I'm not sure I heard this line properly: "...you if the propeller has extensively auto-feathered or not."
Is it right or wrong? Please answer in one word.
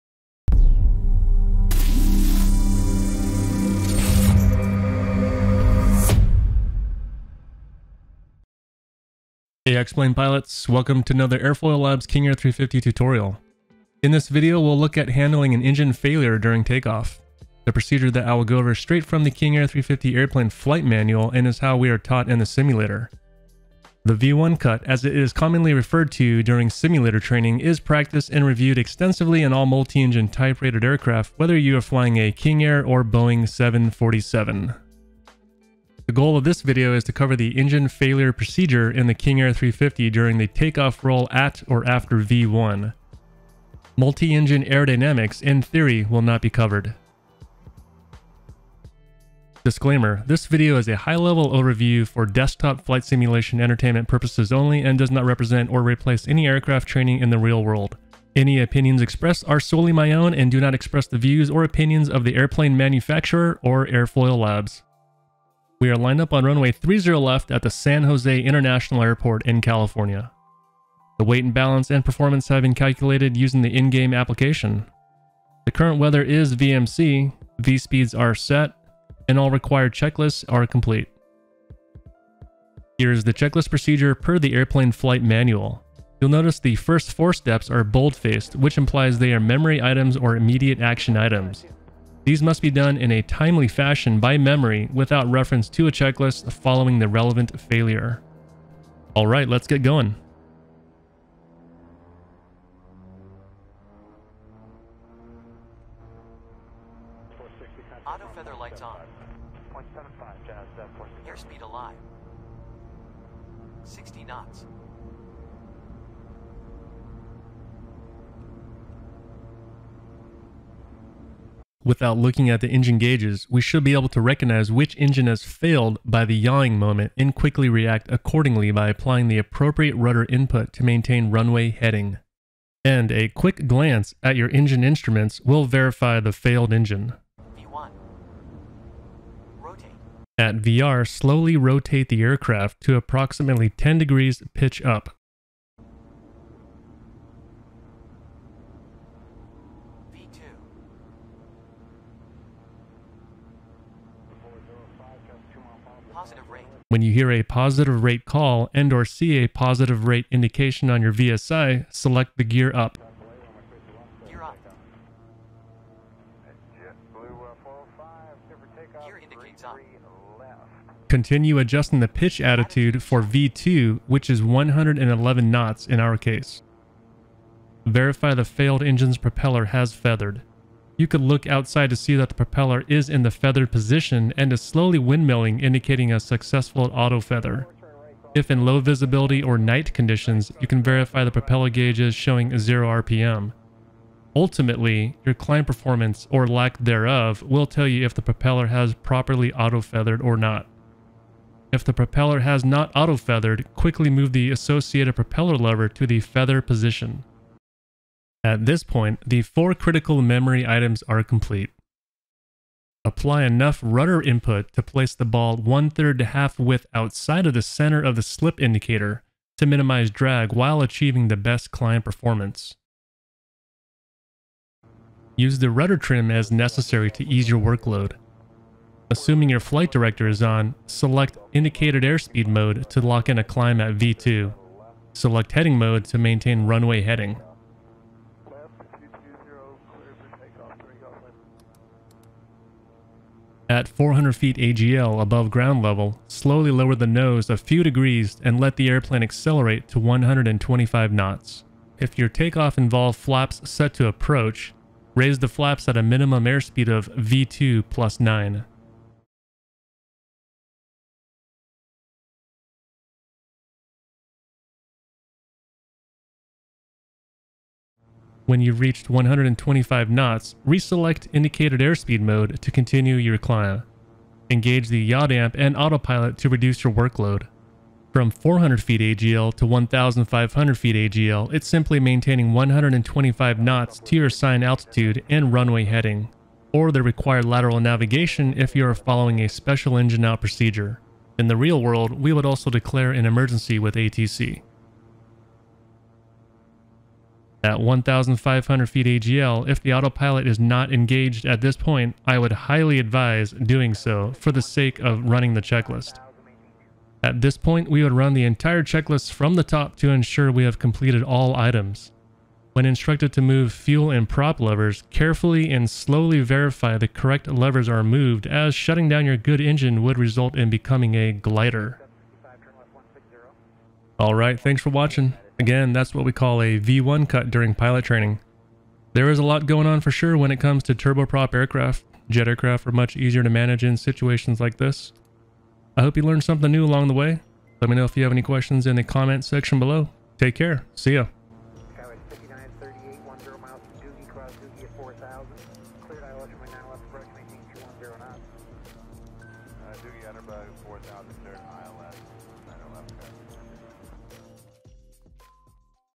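wrong.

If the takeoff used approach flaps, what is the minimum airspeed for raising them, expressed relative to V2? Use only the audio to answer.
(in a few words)
V2 plus 9.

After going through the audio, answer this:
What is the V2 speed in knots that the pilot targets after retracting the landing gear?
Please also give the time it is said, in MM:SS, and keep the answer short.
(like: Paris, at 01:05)
111 knots, at 02:54.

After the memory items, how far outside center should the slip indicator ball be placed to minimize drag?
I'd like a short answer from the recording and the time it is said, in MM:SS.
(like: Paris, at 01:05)
One-third to half-width, at 03:35.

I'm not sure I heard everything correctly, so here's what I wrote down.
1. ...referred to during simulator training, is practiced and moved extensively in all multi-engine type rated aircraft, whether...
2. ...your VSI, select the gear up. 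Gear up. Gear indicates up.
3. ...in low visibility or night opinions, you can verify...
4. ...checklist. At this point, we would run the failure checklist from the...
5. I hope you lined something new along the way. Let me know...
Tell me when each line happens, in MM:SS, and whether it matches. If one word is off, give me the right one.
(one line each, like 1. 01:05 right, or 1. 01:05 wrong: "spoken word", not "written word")
1. 00:25 wrong: "reviewed", not "moved"
2. 02:41 right
3. 03:08 wrong: "conditions", not "opinions"
4. 05:05 wrong: "entire", not "failure"
5. 05:35 wrong: "learned", not "lined".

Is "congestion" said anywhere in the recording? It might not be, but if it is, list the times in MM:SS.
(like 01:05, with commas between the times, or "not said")
not said.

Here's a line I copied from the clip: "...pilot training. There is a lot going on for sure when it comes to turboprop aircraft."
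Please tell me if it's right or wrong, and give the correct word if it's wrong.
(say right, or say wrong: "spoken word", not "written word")
right.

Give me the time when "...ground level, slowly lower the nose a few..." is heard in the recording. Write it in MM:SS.
04:05.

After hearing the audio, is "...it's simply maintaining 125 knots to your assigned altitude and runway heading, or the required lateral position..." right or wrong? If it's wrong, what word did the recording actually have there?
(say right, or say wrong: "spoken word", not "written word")
wrong: "navigation", not "position".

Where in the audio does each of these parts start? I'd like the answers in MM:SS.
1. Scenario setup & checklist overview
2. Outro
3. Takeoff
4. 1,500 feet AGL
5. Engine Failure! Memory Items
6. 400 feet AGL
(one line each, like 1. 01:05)
1. 01:05
2. 05:23
3. 01:39
4. 04:56
5. 01:59
6. 04:02.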